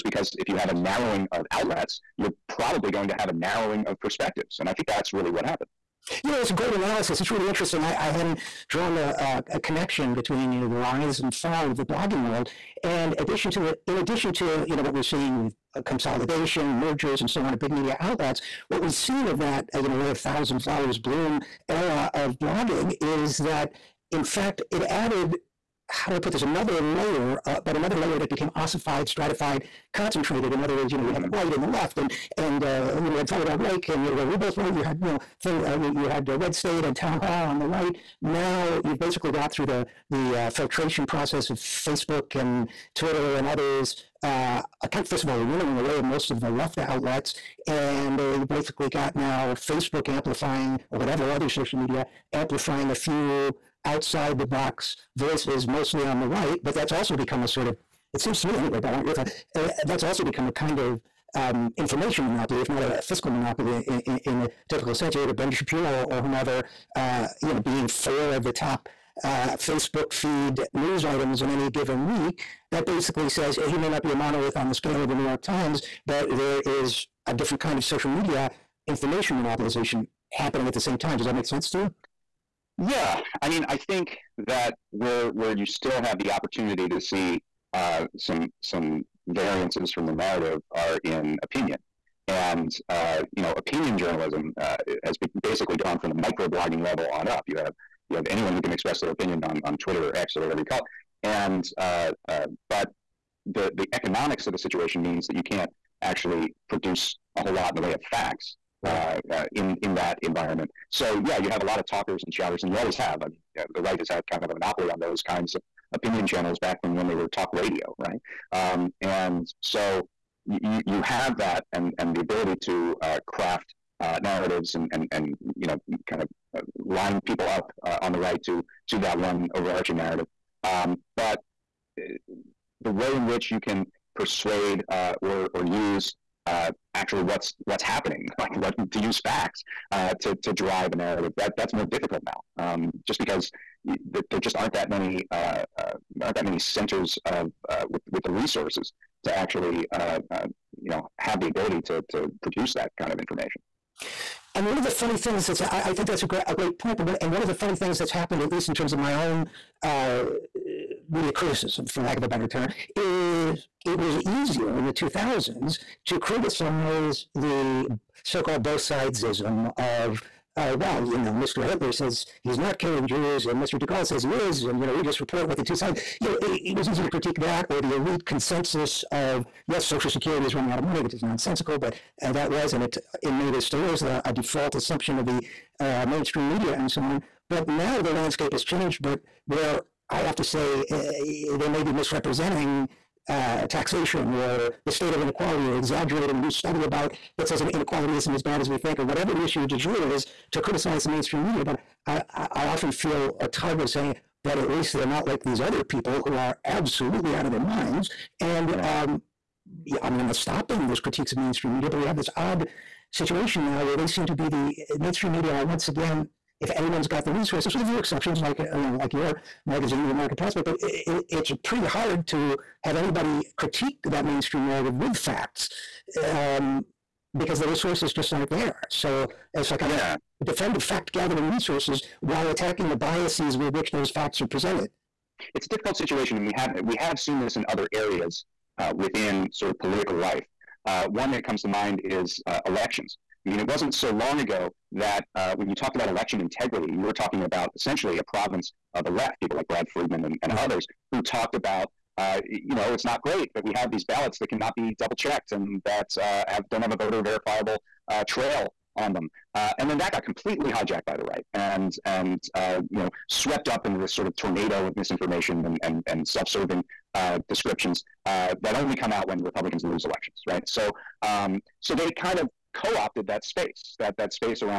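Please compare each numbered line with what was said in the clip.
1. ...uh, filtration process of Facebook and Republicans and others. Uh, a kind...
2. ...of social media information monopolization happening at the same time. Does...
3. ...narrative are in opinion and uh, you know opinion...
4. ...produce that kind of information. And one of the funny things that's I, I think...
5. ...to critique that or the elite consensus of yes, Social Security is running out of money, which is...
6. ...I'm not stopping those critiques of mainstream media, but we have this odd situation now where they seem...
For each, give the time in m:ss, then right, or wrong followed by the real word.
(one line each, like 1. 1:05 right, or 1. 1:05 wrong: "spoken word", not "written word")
1. 0:40 wrong: "Twitter", not "Republicans"
2. 1:17 right
3. 1:30 right
4. 2:32 right
5. 2:57 right
6. 3:30 right.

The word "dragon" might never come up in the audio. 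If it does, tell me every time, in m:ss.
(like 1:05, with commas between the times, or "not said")
not said.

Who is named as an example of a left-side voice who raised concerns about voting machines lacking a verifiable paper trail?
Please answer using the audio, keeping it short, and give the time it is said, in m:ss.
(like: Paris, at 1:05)
Brad Friedman, at 4:09.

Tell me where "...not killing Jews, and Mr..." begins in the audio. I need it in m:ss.
2:52.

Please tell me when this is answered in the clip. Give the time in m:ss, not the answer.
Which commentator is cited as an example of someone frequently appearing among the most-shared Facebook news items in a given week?
1:05.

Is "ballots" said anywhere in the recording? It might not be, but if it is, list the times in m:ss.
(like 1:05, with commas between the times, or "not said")
4:14.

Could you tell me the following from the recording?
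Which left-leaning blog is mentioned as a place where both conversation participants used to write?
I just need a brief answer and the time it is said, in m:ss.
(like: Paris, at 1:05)
Firedoglake, at 0:33.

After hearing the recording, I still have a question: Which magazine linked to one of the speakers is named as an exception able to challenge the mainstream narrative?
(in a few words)
The American Prospect.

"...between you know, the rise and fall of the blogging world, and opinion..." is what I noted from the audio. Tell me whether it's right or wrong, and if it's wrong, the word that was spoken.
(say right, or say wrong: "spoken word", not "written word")
wrong: "addition", not "opinion".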